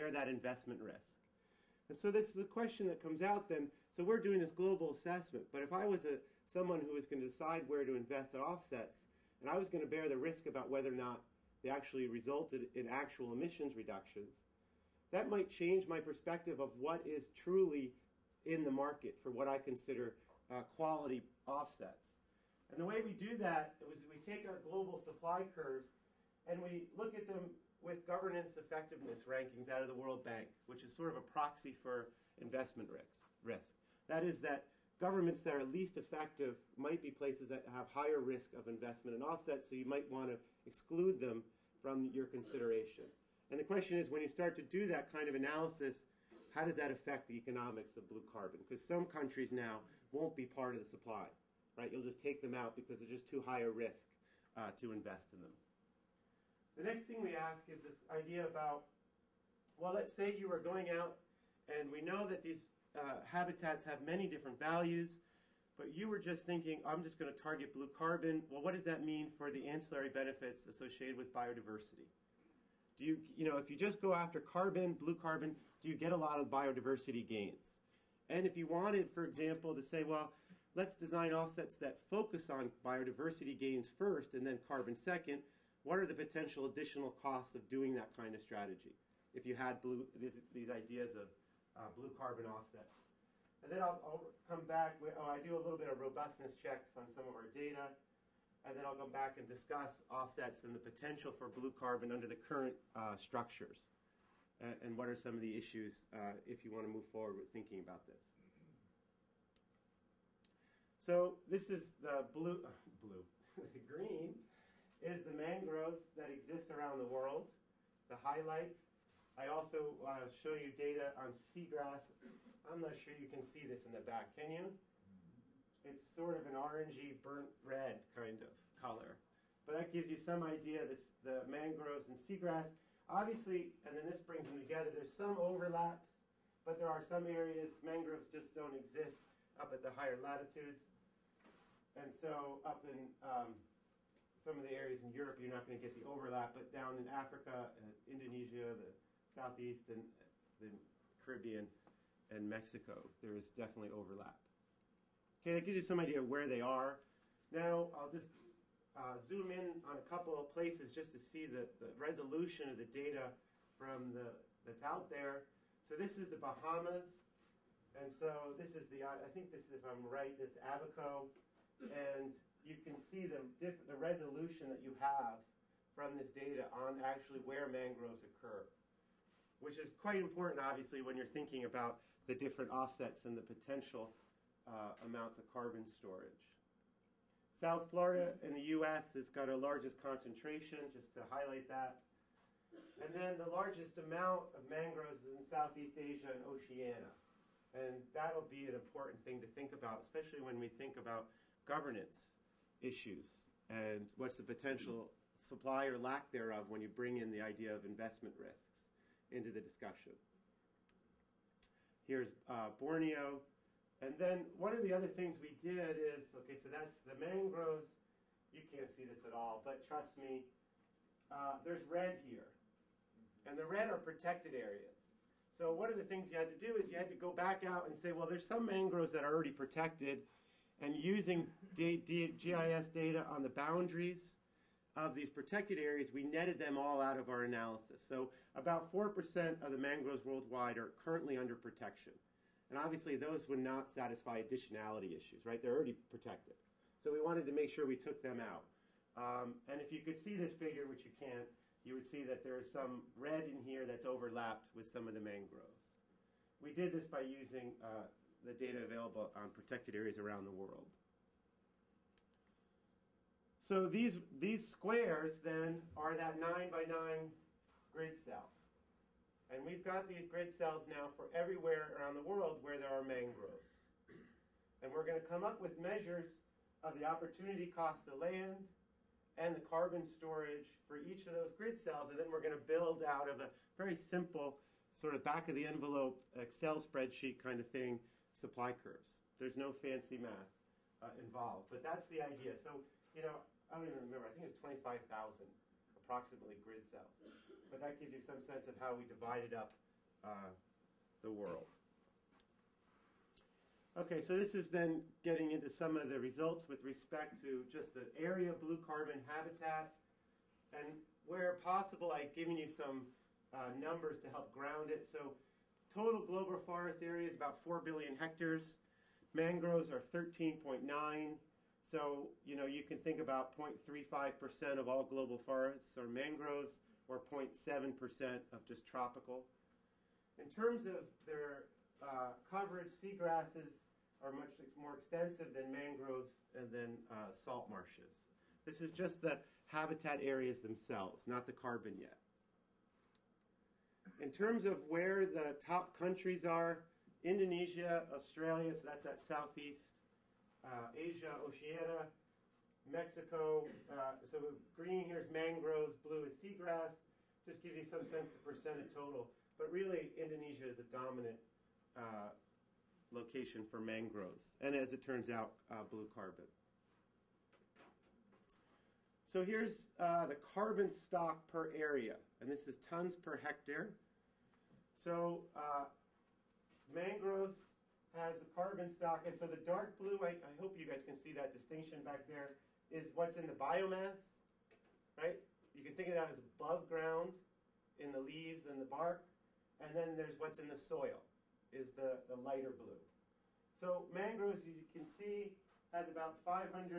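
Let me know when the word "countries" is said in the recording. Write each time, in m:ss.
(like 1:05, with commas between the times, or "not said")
0:49, 5:45.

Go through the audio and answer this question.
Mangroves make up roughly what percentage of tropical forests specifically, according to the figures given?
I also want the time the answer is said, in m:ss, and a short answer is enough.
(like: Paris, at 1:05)
0.7%, at 5:27.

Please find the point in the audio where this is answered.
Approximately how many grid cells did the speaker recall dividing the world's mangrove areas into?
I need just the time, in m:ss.
4:54.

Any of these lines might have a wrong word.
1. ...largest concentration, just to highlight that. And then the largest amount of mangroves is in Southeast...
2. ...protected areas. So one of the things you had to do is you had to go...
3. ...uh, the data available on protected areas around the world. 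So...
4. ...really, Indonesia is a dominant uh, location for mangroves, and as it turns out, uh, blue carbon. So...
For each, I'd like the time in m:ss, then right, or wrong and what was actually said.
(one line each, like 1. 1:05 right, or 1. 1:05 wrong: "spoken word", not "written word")
1. 3:09 right
2. 3:43 right
3. 4:17 right
4. 5:59 right.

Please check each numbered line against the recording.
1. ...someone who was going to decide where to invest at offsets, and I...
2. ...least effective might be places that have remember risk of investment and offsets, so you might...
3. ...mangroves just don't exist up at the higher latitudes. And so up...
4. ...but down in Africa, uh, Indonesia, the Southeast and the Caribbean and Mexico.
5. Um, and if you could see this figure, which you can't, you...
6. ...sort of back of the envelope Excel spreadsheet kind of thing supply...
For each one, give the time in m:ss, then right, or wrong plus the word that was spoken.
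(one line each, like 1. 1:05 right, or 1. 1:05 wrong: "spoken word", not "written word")
1. 0:06 right
2. 0:35 wrong: "higher", not "remember"
3. 2:17 right
4. 2:26 right
5. 4:09 right
6. 4:44 right.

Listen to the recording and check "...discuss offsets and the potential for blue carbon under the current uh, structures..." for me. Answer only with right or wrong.
right.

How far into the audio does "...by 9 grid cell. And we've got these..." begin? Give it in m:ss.
4:26.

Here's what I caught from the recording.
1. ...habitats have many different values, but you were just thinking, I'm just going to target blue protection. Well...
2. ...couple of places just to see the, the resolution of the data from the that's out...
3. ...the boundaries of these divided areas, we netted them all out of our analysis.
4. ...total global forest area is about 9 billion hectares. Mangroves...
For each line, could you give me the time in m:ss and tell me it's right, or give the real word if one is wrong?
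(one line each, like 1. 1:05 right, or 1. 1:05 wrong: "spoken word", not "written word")
1. 1:03 wrong: "carbon", not "protection"
2. 2:40 right
3. 3:53 wrong: "protected", not "divided"
4. 5:15 wrong: "4", not "9".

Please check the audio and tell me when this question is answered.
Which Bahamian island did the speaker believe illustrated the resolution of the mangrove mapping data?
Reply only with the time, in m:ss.
2:50.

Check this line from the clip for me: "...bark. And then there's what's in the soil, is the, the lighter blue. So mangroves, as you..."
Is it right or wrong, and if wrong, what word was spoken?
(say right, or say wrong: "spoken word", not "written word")
right.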